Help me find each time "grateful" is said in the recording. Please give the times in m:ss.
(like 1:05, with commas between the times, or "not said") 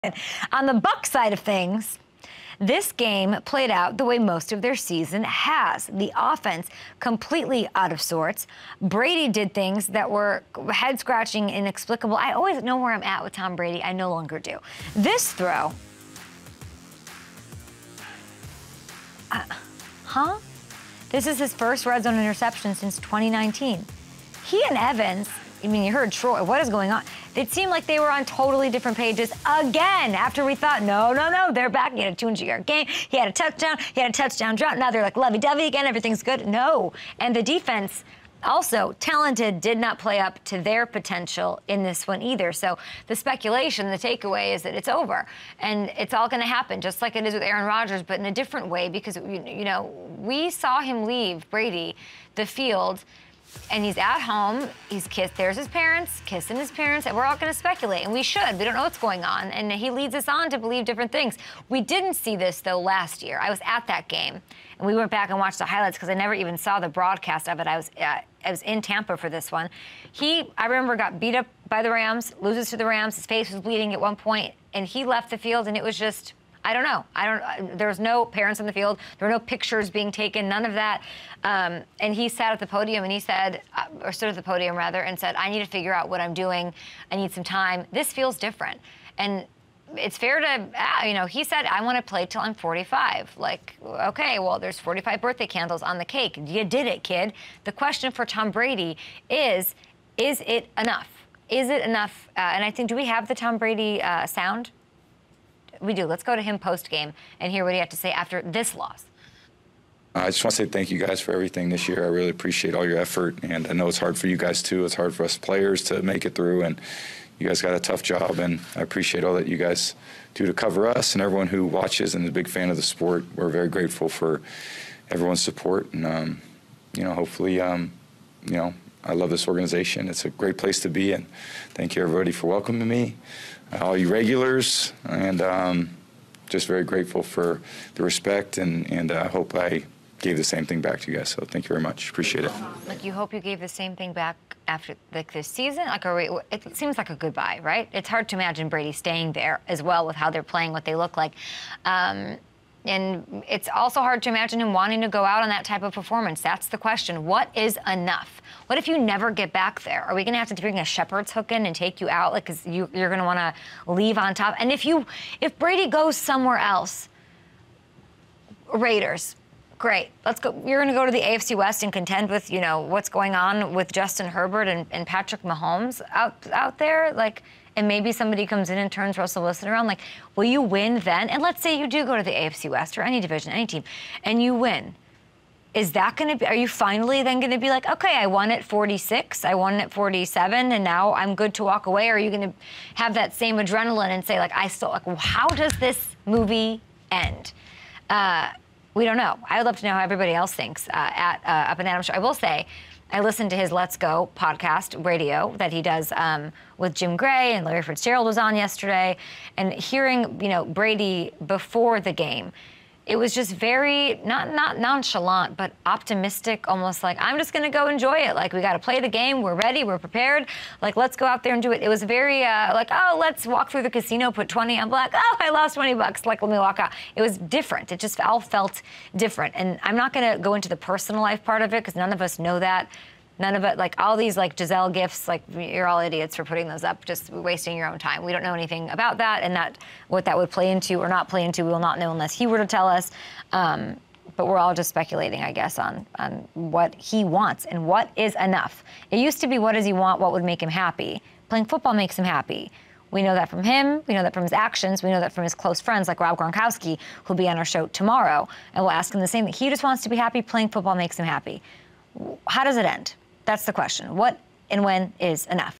2:03, 2:16.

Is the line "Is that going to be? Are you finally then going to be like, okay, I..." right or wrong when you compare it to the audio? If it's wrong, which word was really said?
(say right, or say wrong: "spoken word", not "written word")
right.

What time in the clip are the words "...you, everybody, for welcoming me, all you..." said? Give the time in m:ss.
2:11.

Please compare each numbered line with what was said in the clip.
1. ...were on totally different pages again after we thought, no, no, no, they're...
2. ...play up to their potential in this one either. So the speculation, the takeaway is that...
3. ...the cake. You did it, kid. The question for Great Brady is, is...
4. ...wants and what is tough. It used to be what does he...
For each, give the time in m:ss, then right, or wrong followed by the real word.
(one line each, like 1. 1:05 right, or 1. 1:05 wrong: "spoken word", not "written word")
1. 0:27 right
2. 0:39 right
3. 1:35 wrong: "Tom", not "Great"
4. 4:07 wrong: "enough", not "tough".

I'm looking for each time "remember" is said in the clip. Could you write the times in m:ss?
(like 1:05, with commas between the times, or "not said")
1:10.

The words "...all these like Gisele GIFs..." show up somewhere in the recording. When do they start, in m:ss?
3:53.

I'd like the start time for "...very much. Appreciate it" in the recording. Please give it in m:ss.
2:21.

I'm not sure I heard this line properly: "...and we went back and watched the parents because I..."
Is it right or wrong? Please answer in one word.
wrong.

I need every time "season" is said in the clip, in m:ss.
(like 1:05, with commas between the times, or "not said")
0:04, 2:25.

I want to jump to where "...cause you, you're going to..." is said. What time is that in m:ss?
2:42.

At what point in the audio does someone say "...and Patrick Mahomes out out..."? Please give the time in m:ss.
2:54.